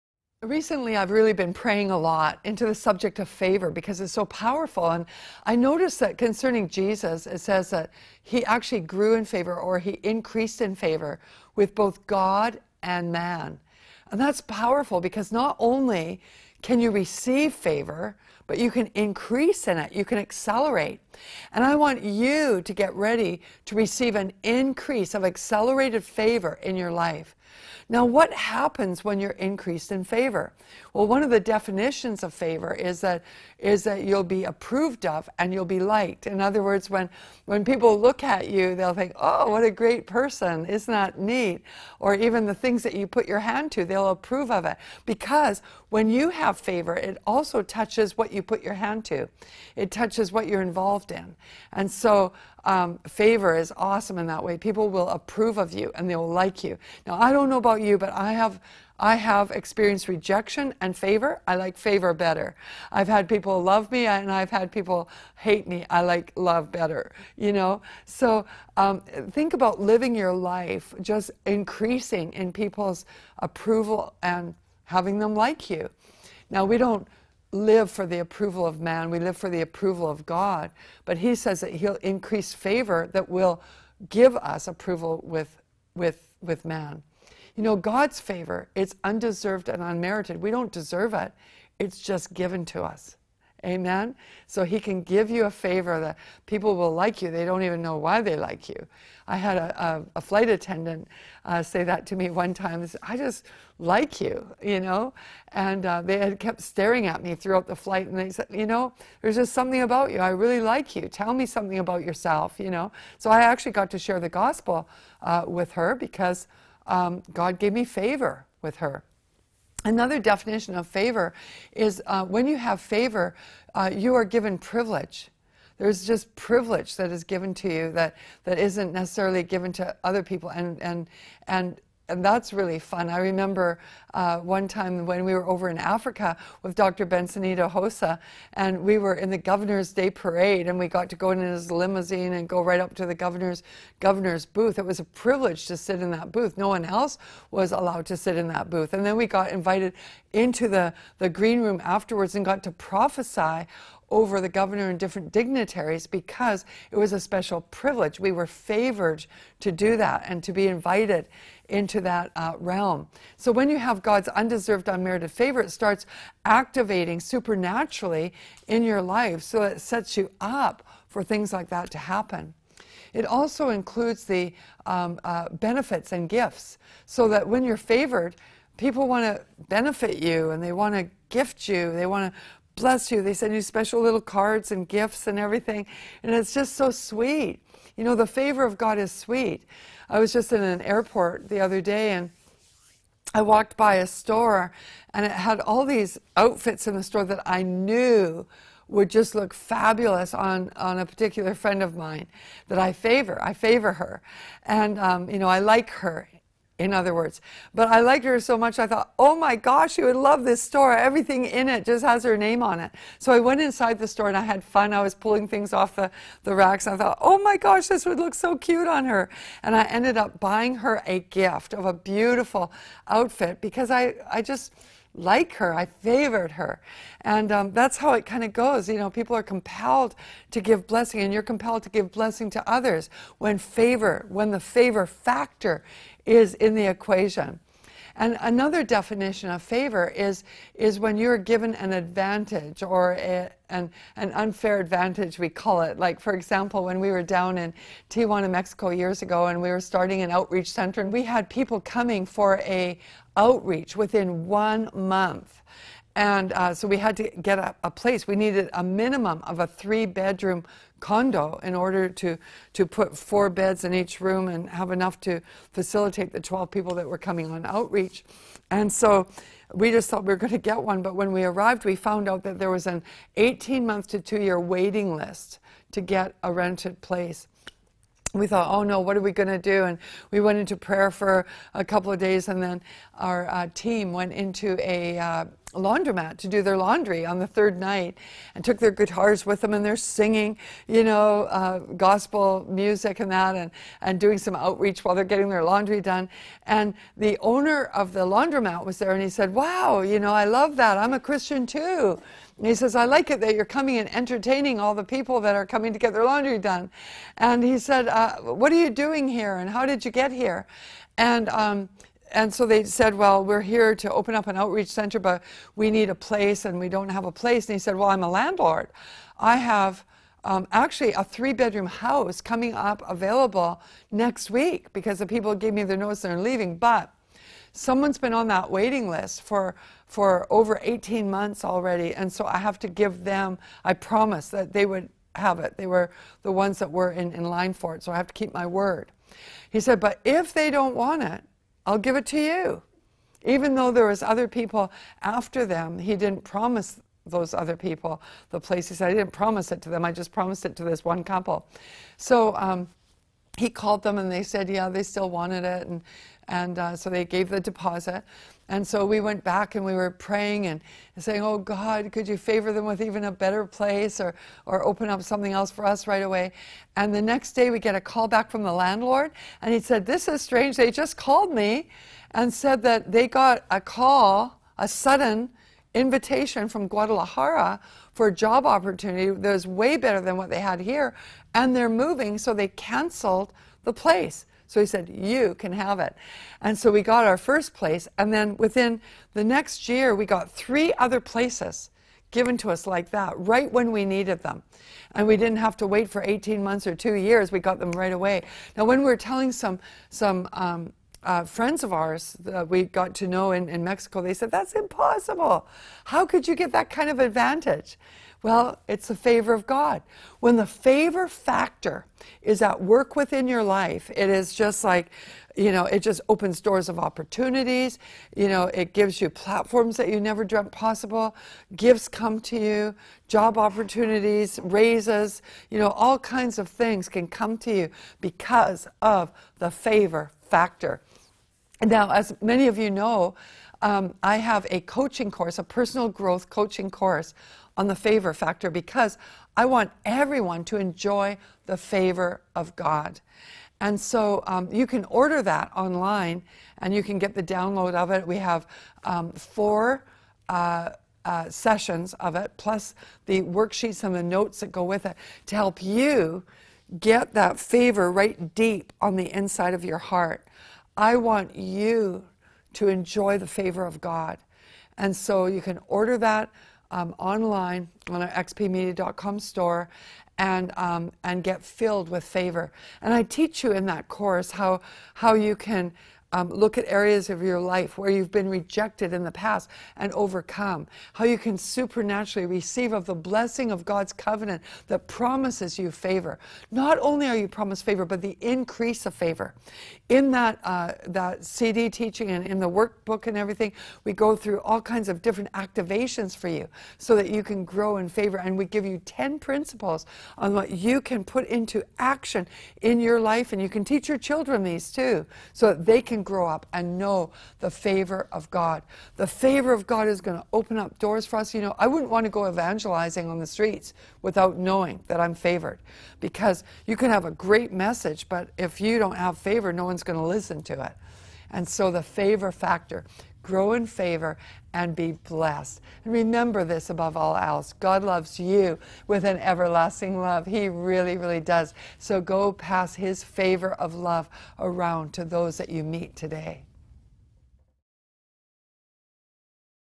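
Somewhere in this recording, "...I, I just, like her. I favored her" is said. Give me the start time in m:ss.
3:43.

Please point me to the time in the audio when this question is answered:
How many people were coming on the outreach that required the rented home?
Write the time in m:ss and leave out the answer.
4:26.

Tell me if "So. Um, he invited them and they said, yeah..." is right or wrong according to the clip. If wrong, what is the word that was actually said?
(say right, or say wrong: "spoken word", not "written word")
wrong: "called", not "invited".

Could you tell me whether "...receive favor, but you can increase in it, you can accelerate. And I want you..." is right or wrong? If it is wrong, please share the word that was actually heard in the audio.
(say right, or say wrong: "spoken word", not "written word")
right.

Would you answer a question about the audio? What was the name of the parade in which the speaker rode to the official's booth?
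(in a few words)
Governor's Day Parade.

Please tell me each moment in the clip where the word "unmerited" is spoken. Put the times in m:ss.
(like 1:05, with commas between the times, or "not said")
1:29, 2:44.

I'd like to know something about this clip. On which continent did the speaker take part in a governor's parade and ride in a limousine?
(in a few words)
Africa.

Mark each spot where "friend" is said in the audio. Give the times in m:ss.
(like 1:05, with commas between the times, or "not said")
3:21, 6:41.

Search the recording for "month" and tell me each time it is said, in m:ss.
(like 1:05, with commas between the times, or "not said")
4:14, 4:33, 5:31, 6:36.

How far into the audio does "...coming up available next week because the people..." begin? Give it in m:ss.
5:22.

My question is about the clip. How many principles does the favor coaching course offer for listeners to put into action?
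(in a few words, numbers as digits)
10.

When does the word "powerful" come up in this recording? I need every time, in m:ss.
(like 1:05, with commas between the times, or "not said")
0:04, 0:14.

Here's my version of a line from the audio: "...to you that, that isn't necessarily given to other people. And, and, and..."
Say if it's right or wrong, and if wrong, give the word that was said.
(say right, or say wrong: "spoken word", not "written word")
right.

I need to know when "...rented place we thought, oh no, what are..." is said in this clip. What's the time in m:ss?
4:36.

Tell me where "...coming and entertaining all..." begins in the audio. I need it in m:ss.
5:03.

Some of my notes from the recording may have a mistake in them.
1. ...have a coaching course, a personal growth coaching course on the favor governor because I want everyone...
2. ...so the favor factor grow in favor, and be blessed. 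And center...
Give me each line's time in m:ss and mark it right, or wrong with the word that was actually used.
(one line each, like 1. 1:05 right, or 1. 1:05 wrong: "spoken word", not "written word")
1. 7:14 wrong: "factor", not "governor"
2. 8:41 wrong: "remember", not "center".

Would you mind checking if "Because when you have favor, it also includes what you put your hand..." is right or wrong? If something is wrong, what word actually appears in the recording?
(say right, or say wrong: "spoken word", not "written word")
wrong: "touches", not "includes".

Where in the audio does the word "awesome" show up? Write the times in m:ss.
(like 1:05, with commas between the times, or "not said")
0:53.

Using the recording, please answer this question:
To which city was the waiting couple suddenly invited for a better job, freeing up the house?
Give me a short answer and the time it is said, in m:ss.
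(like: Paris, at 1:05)
Guadalajara, at 6:16.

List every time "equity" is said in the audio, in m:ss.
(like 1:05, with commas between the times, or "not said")
not said.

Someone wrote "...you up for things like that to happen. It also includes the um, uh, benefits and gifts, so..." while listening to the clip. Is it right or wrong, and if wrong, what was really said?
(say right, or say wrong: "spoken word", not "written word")
right.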